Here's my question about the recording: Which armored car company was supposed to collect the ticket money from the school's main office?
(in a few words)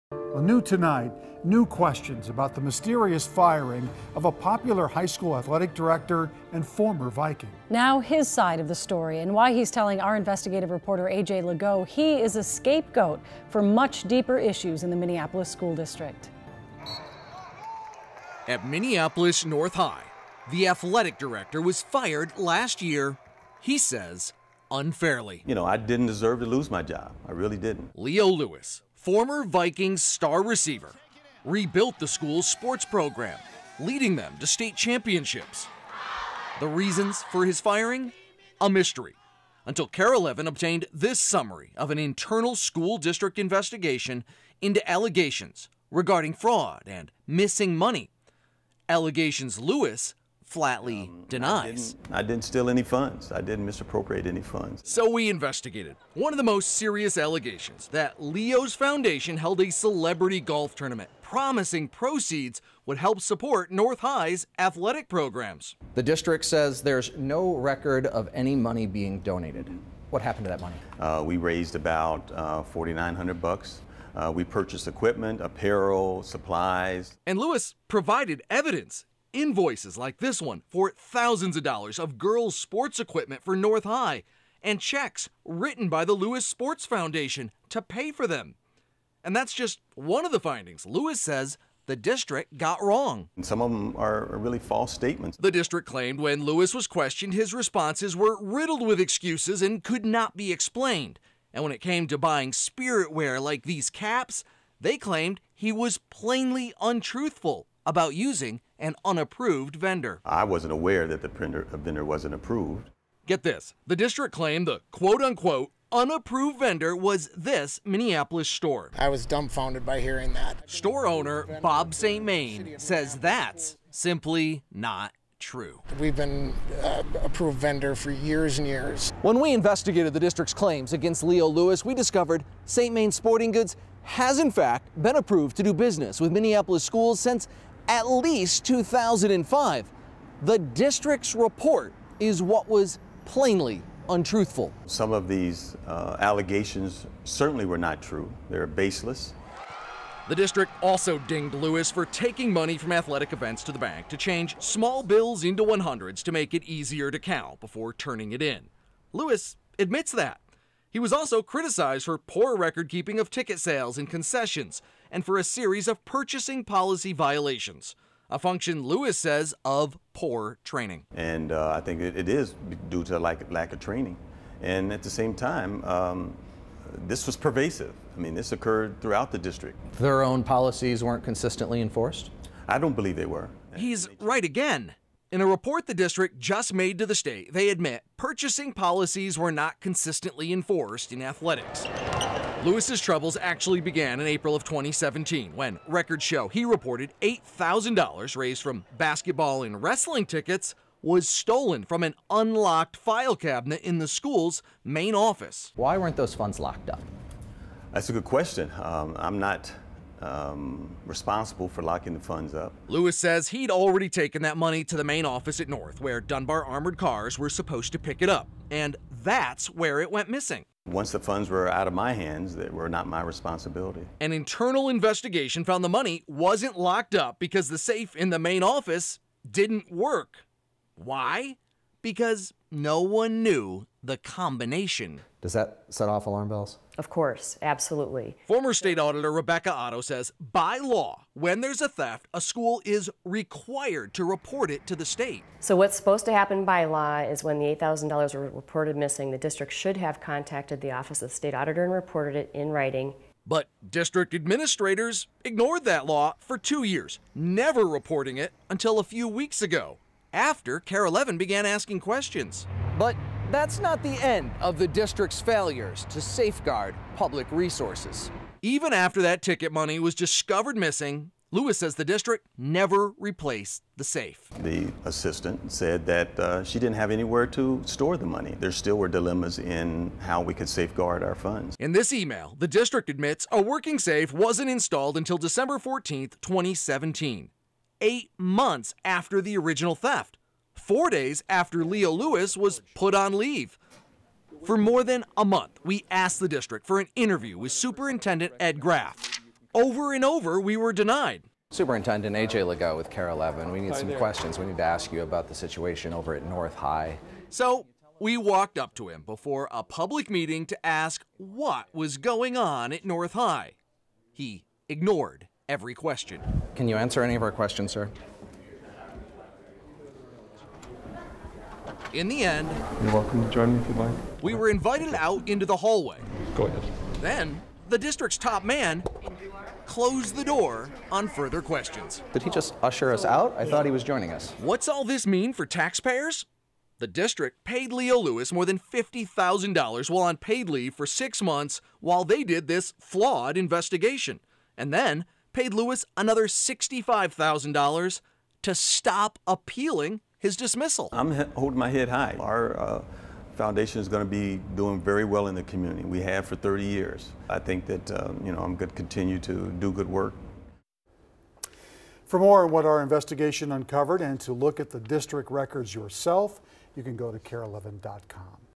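Dunbar.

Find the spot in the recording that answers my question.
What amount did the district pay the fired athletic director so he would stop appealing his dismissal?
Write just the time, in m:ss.
5:46.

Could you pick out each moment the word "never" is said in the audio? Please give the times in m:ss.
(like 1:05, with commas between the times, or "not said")
4:17, 4:32.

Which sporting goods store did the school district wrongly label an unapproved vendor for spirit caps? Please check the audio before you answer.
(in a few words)
St. Main Sporting Goods.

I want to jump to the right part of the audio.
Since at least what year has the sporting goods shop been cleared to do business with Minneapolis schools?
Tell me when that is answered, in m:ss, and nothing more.
2:18.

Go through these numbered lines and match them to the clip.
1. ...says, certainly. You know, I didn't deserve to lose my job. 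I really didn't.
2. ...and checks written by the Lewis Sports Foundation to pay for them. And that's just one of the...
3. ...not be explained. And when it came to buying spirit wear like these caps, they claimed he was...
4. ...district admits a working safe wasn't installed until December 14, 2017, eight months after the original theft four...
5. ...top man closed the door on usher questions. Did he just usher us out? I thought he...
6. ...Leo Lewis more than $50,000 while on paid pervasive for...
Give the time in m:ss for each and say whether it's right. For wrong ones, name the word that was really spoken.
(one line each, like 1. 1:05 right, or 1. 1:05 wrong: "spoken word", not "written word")
1. 0:23 wrong: "unfairly", not "certainly"
2. 1:24 right
3. 1:40 right
4. 4:42 right
5. 5:28 wrong: "further", not "usher"
6. 5:37 wrong: "leave", not "pervasive".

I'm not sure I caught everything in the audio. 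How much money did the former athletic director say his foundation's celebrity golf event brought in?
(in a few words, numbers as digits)
$4,900.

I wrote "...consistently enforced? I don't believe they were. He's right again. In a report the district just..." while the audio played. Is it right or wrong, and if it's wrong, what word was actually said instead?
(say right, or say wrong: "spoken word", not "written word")
right.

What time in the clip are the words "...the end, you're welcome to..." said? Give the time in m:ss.
5:22.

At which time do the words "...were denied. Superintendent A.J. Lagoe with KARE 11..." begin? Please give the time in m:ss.
5:00.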